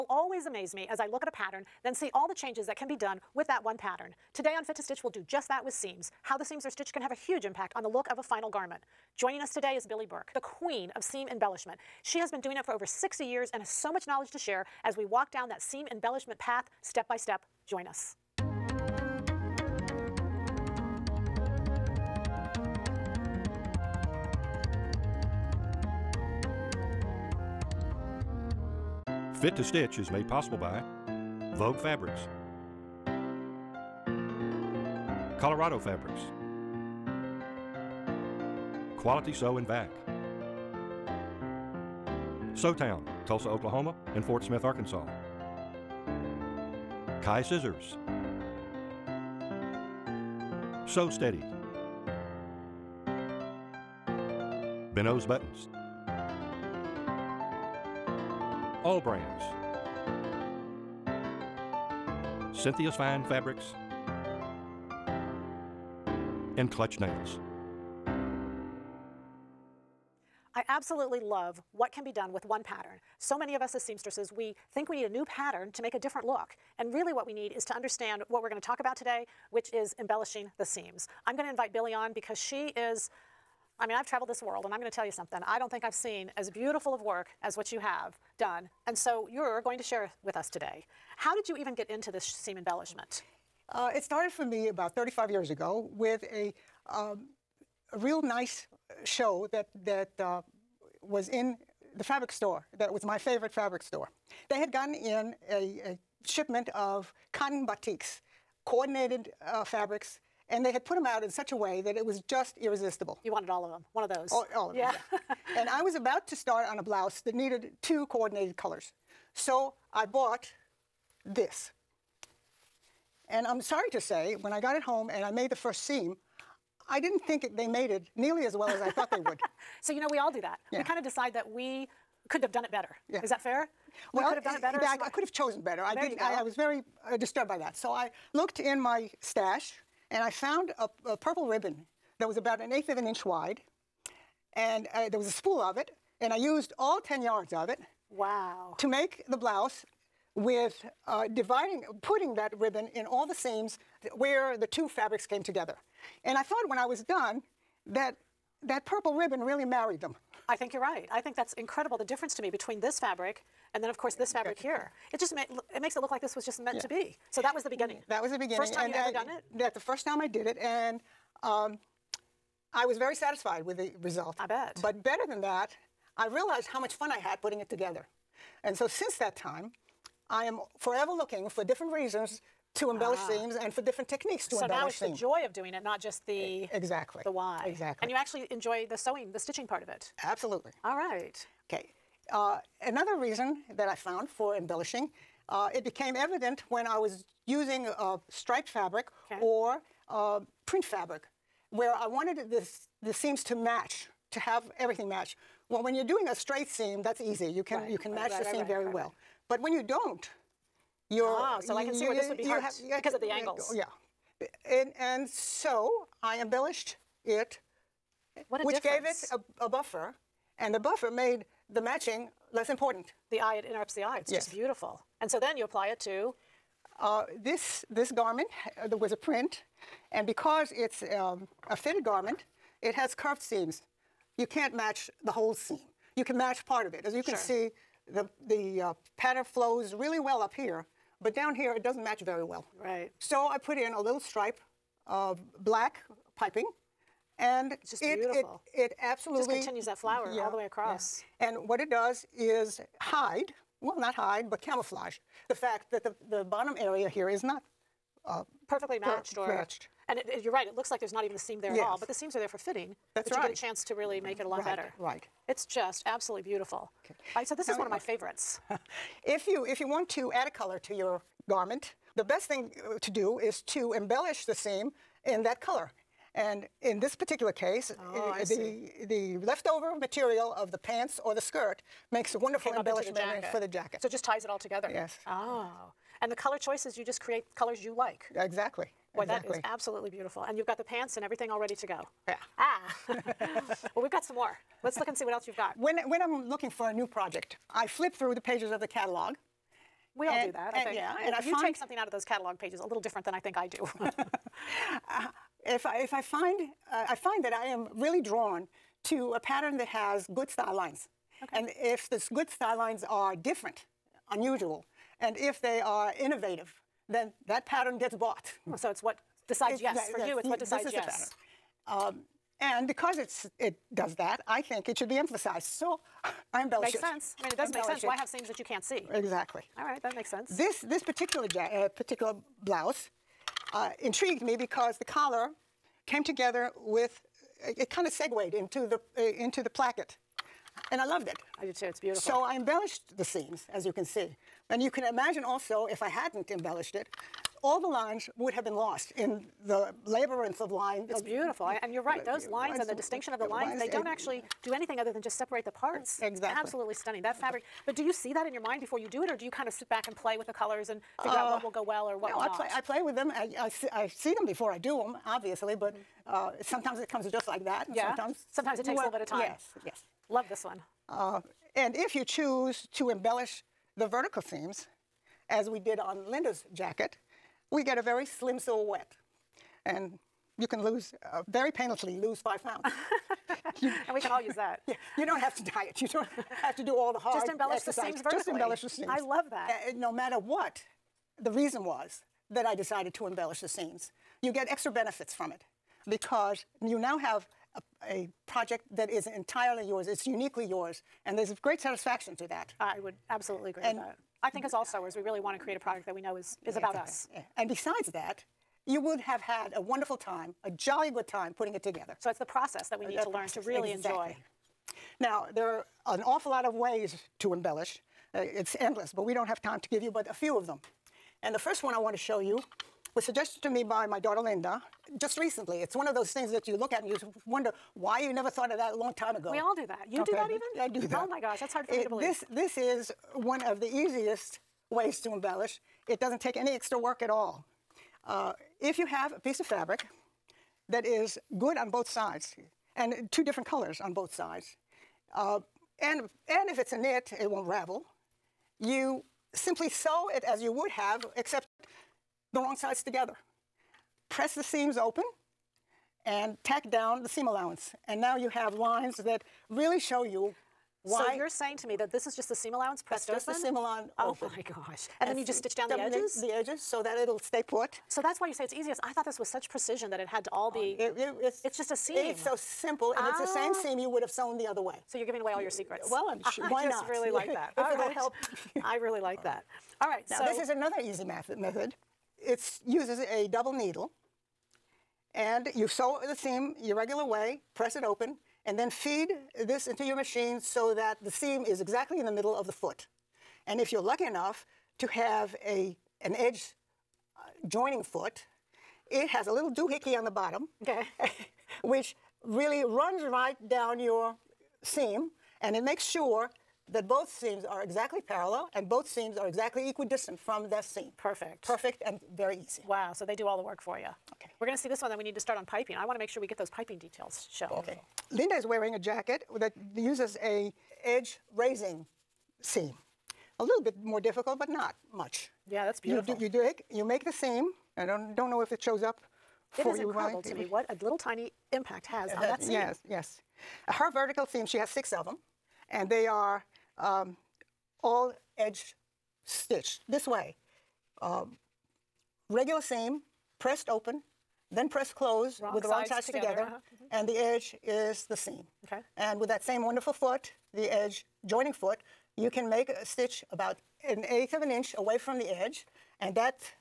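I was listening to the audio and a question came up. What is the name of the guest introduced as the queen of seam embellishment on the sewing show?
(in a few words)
Billy Burke.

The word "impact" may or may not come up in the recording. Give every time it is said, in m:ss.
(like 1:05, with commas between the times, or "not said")
0:07, 8:51.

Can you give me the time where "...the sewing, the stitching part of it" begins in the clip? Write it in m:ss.
3:08.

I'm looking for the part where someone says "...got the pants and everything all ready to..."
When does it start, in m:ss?
4:50.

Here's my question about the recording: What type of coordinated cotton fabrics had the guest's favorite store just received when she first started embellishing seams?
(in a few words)
Cotton batiks.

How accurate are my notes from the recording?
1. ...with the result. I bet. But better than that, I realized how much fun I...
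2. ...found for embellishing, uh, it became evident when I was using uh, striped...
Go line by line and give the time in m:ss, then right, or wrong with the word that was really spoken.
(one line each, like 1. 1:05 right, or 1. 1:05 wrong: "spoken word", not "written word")
1. 2:53 right
2. 3:13 right.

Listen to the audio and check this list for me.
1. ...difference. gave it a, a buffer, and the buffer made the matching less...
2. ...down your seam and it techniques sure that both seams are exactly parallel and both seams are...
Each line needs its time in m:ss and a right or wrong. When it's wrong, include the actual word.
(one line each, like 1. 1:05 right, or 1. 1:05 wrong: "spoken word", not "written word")
1. 3:38 right
2. 8:23 wrong: "makes", not "techniques".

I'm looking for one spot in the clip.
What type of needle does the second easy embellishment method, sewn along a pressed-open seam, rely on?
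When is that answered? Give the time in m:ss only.
8:03.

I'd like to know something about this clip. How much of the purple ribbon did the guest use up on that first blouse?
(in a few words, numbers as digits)
10 yards.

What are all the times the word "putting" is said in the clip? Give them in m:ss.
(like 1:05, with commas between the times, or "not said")
2:32, 2:57, 6:51.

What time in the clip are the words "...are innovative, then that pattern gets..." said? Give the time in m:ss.
5:15.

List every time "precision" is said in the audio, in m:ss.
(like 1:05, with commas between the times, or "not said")
7:49.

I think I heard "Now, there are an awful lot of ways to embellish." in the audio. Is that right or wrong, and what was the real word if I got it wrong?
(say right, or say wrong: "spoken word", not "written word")
right.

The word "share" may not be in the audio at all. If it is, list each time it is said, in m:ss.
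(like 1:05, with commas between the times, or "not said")
0:14, 1:29.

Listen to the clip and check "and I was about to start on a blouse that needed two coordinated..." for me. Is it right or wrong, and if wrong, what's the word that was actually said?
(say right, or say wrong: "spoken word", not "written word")
right.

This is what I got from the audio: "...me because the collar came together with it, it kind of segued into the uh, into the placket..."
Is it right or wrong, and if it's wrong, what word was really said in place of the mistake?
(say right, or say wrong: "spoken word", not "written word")
right.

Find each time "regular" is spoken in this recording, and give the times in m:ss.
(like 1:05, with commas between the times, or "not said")
8:06, 9:02.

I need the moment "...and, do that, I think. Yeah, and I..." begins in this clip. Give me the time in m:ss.
5:00.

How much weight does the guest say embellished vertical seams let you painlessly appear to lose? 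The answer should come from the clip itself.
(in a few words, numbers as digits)
5 pounds.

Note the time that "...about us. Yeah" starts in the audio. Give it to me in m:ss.
6:46.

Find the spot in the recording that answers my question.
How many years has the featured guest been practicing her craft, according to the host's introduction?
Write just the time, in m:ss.
0:12.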